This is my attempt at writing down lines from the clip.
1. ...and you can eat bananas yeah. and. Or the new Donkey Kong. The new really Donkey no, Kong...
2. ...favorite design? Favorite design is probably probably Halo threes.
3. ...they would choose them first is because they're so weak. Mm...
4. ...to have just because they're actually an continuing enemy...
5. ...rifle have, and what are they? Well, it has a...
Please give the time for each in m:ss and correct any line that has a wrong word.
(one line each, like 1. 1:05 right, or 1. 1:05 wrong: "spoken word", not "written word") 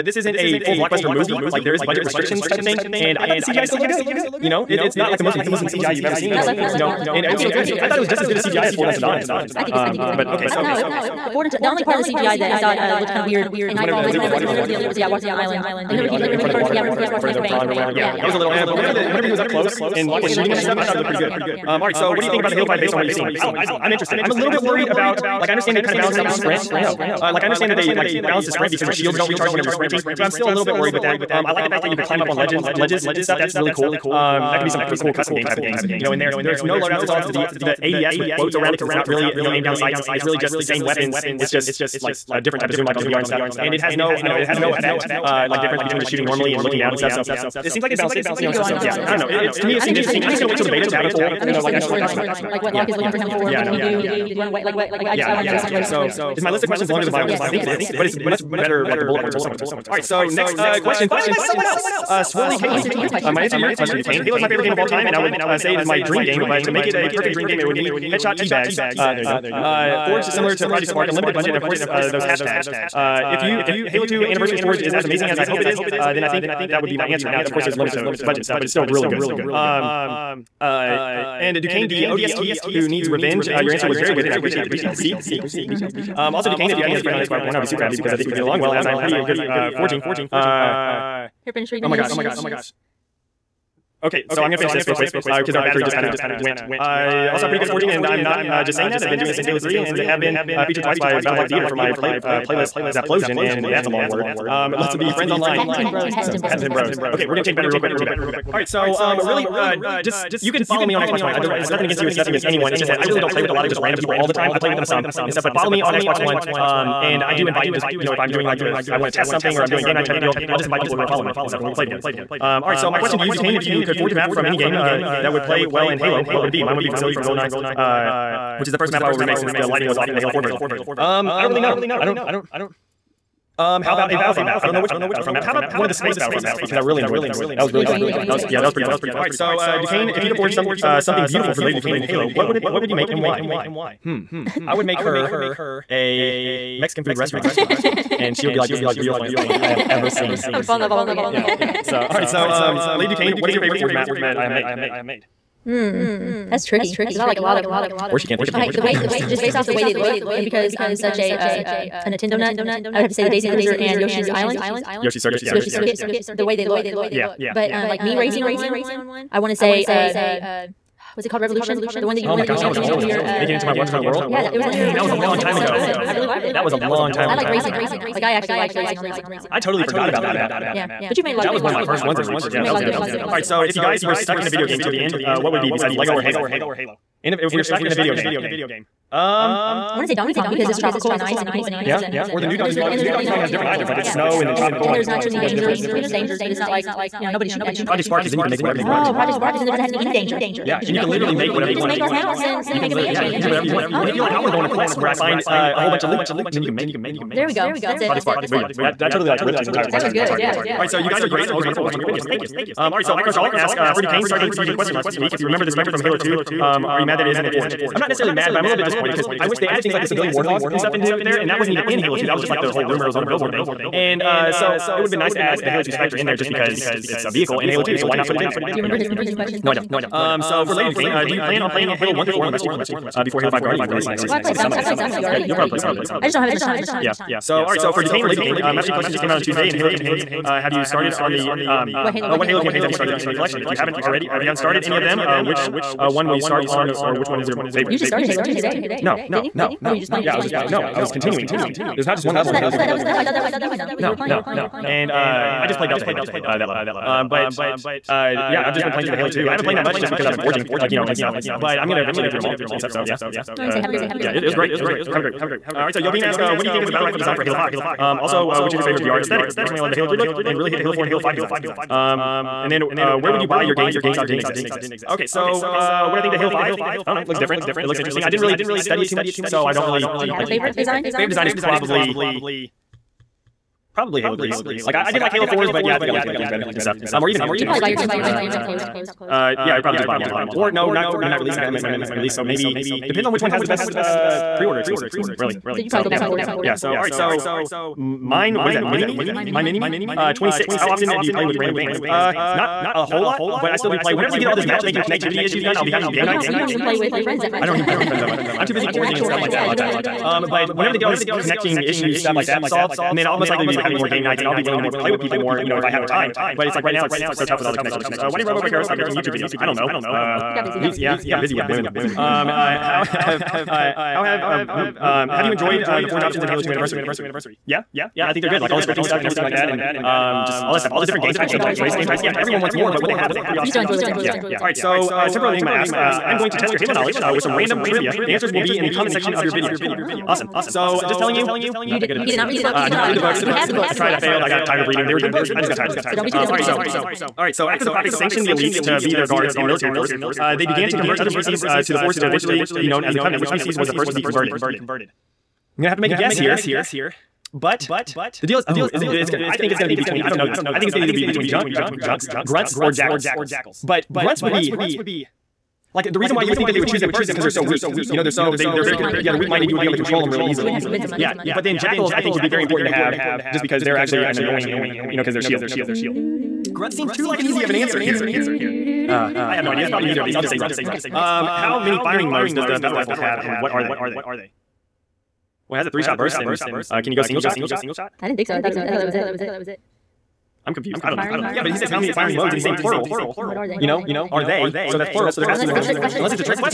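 1. 3:11 right
2. 4:40 right
3. 6:06 right
4. 6:12 wrong: "annoying", not "continuing"
5. 6:22 right.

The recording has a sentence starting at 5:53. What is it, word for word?
Which species was the first to be converted?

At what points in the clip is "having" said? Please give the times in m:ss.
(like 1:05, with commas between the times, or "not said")
5:05, 5:13.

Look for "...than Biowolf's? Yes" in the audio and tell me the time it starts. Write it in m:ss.
0:57.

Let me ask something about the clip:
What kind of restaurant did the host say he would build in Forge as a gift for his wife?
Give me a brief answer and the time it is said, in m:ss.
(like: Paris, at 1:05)
Mexican food restaurant, at 2:26.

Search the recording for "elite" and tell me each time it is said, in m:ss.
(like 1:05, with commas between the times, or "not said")
0:14, 5:48.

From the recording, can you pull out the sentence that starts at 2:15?
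How about one of the space Battlefront maps?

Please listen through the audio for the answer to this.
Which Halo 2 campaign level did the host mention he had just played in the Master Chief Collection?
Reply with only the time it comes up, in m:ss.
4:15.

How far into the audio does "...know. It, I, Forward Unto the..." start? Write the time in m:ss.
0:10.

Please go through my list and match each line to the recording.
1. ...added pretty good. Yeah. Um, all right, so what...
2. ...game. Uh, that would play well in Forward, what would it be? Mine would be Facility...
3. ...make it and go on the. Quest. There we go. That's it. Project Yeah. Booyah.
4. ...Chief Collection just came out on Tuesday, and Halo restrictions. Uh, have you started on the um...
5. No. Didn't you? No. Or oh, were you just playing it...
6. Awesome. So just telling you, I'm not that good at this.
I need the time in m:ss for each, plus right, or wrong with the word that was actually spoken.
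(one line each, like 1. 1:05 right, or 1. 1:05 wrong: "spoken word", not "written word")
1. 0:20 wrong: "looked", not "added"
2. 2:04 wrong: "Halo", not "Forward"
3. 3:26 wrong: "Spark", not "Yeah"
4. 3:58 wrong: "campaigns", not "restrictions"
5. 4:09 right
6. 5:40 right.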